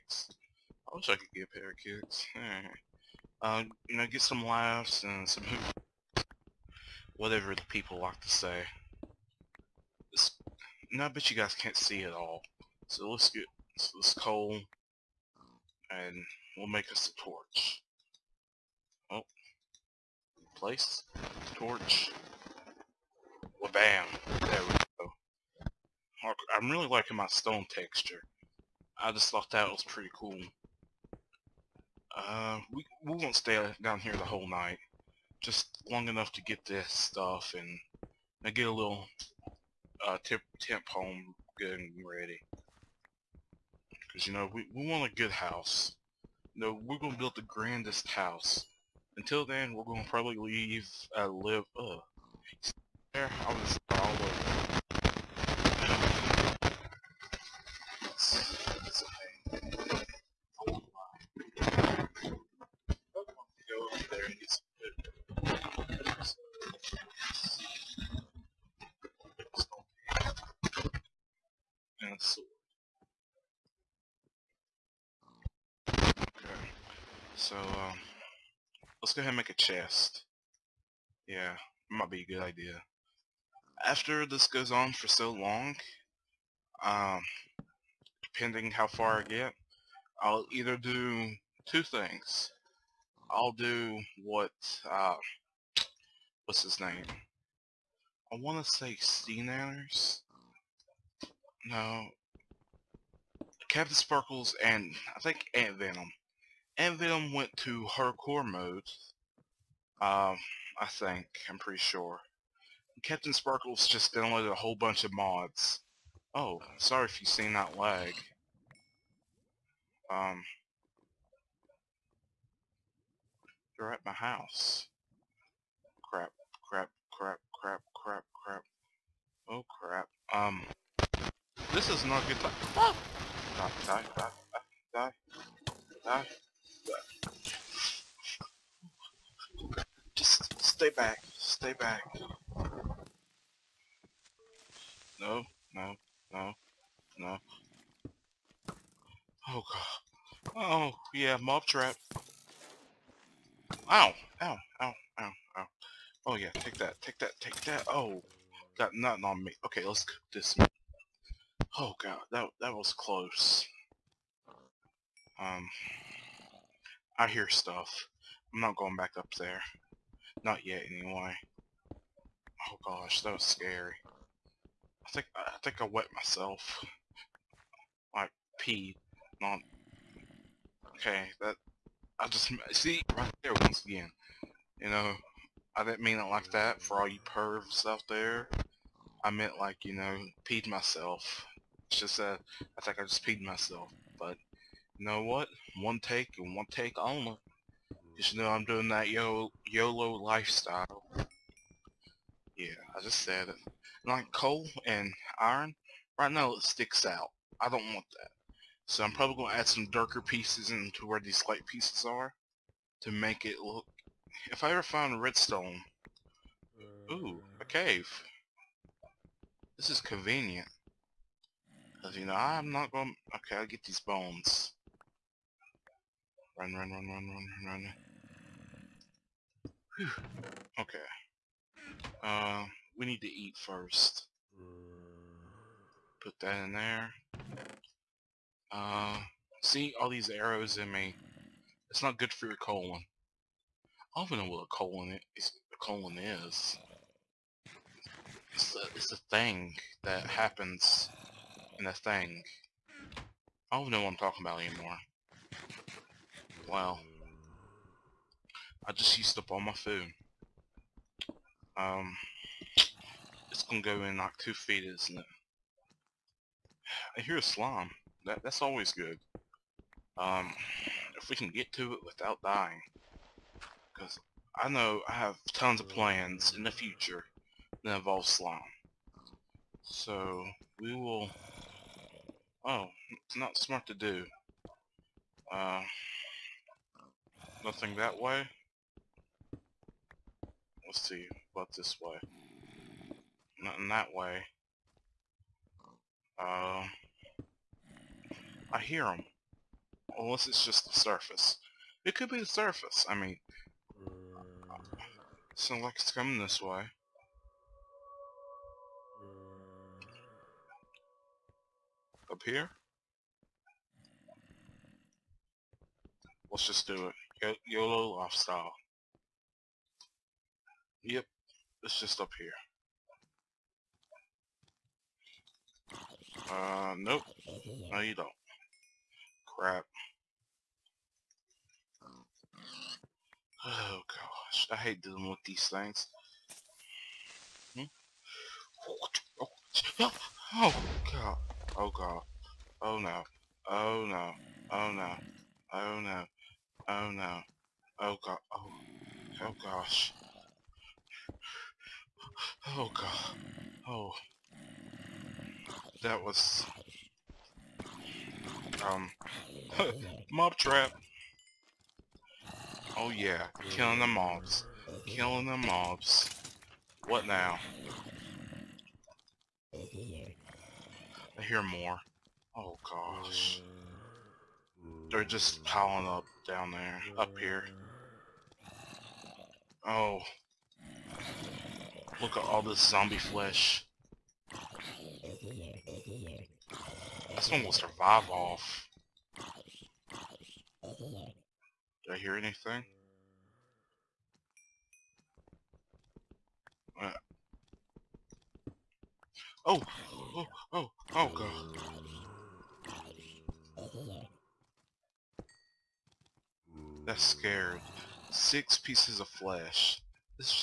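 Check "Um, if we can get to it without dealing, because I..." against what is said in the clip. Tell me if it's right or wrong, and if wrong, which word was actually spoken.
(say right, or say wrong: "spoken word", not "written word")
wrong: "dying", not "dealing".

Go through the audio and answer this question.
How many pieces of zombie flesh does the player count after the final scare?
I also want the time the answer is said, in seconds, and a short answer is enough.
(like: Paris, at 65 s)
6, at 408 s.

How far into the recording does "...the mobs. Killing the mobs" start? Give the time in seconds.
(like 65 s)
363 s.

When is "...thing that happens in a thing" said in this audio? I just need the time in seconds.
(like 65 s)
249 s.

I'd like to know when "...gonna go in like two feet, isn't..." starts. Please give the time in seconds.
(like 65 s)
263 s.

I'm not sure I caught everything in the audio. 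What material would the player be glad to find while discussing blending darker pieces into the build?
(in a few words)
redstone.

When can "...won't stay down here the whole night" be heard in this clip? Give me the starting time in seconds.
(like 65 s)
33 s.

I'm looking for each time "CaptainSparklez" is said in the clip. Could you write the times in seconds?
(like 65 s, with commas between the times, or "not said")
103 s, 113 s.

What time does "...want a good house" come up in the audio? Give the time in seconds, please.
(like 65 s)
44 s.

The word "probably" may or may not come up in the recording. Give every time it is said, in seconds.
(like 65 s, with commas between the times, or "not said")
50 s, 209 s.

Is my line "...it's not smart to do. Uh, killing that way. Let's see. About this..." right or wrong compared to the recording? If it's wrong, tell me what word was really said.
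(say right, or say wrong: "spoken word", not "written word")
wrong: "nothing", not "killing".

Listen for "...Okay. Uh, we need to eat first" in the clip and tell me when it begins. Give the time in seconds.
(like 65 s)
230 s.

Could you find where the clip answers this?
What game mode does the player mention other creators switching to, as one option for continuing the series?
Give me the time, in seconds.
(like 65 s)
107 s.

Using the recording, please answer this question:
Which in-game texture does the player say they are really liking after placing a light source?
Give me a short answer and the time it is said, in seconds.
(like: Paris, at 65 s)
stone texture, at 27 s.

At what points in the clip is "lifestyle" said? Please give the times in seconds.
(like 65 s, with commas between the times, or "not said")
200 s, 318 s.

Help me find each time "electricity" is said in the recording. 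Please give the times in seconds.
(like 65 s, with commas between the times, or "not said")
not said.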